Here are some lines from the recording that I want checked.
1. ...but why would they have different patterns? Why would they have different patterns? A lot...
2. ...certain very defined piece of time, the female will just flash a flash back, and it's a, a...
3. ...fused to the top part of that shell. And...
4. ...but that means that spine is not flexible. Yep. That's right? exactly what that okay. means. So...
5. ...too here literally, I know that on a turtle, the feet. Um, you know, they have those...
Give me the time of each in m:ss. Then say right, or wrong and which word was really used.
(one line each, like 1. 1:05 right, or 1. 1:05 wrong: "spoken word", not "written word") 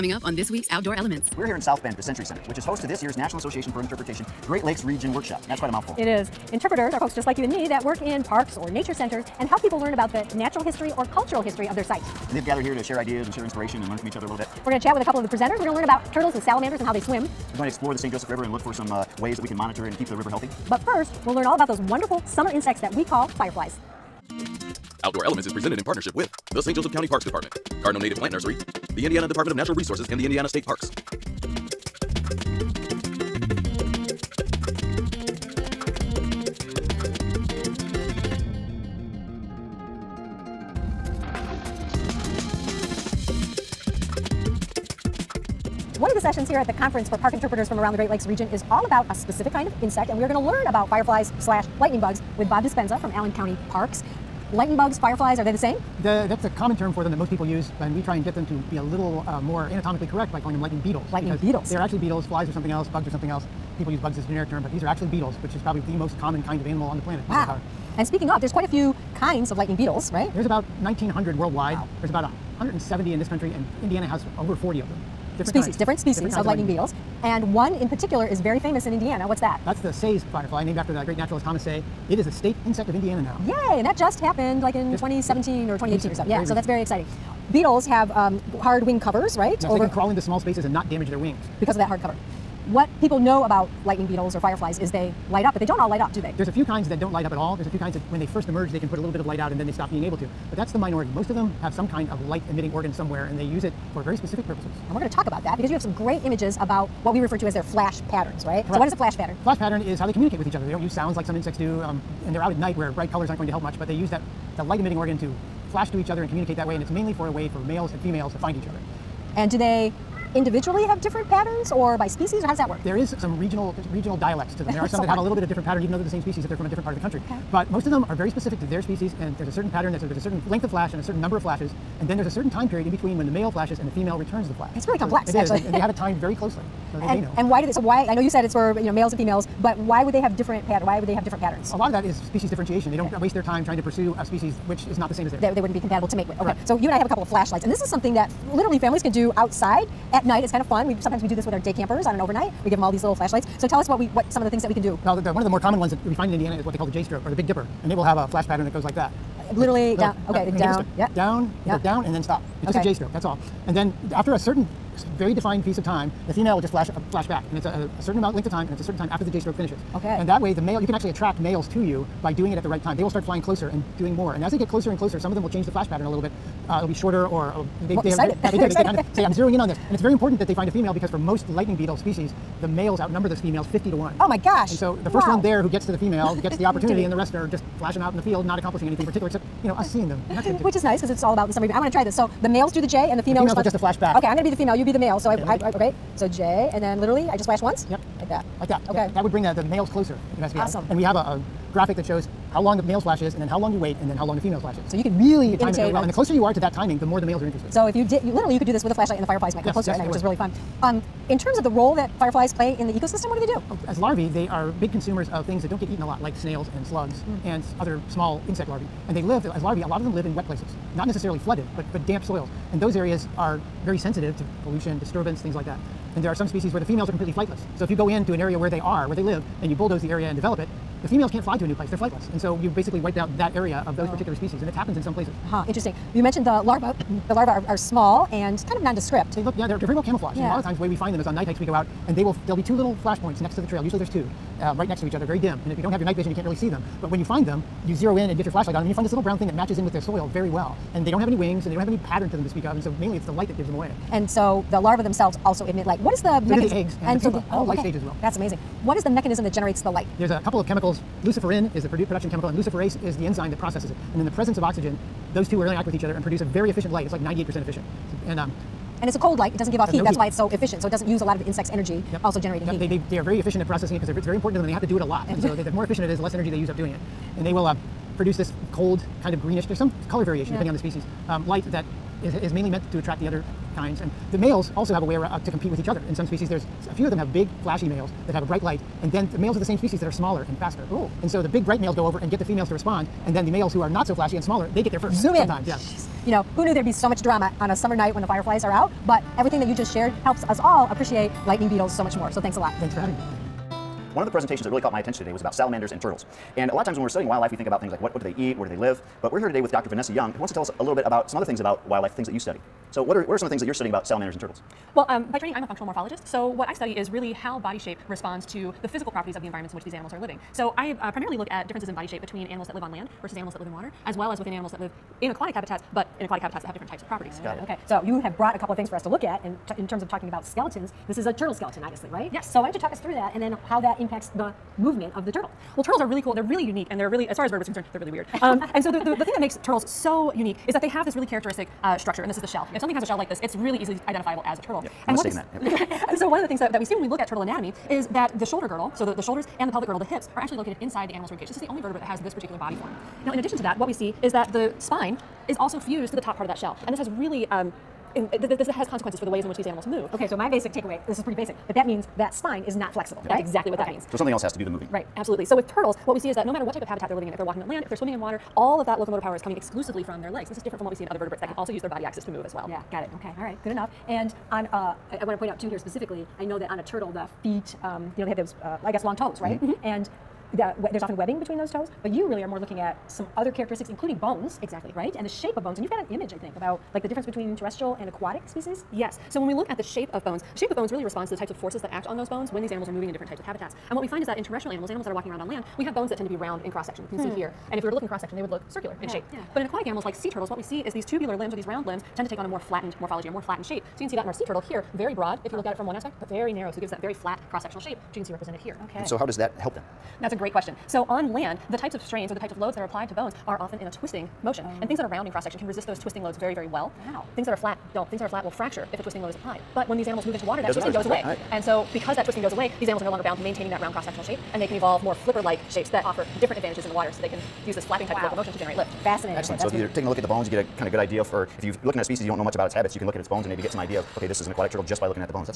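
1. 2:19 right
2. 2:44 right
3. 5:55 right
4. 6:01 right
5. 6:15 wrong: "specifically", not "literally".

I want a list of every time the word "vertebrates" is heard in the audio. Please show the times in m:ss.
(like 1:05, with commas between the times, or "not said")
5:37, 5:51, 6:11.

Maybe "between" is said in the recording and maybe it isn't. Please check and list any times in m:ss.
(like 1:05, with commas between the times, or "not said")
2:12, 5:22, 6:21, 6:27.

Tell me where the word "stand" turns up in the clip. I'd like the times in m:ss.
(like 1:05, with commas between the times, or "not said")
not said.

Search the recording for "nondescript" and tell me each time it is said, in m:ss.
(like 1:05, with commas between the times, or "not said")
3:58.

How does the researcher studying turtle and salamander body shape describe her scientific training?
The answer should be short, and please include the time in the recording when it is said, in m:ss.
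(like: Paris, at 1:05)
functional morphologist, at 5:15.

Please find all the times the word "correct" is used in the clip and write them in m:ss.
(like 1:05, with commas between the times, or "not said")
1:00, 1:48, 2:26.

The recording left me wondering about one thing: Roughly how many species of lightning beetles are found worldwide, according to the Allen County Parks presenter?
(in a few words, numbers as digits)
1,900.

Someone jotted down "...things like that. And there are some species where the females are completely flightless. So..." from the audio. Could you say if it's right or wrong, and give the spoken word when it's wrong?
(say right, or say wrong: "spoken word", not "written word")
right.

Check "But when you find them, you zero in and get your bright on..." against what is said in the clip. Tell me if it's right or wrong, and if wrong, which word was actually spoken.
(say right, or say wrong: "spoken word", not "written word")
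wrong: "flashlight", not "bright".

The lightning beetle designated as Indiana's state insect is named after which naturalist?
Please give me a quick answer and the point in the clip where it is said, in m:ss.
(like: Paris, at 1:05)
Thomas Say, at 1:21.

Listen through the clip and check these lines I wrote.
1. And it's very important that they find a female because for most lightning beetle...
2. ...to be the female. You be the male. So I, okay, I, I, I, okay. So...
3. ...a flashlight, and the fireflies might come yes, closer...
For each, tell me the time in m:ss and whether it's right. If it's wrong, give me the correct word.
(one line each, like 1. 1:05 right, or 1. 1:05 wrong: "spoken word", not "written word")
1. 2:59 right
2. 3:14 right
3. 3:28 right.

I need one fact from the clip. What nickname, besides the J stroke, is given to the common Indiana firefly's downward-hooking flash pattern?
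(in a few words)
Big Dipper.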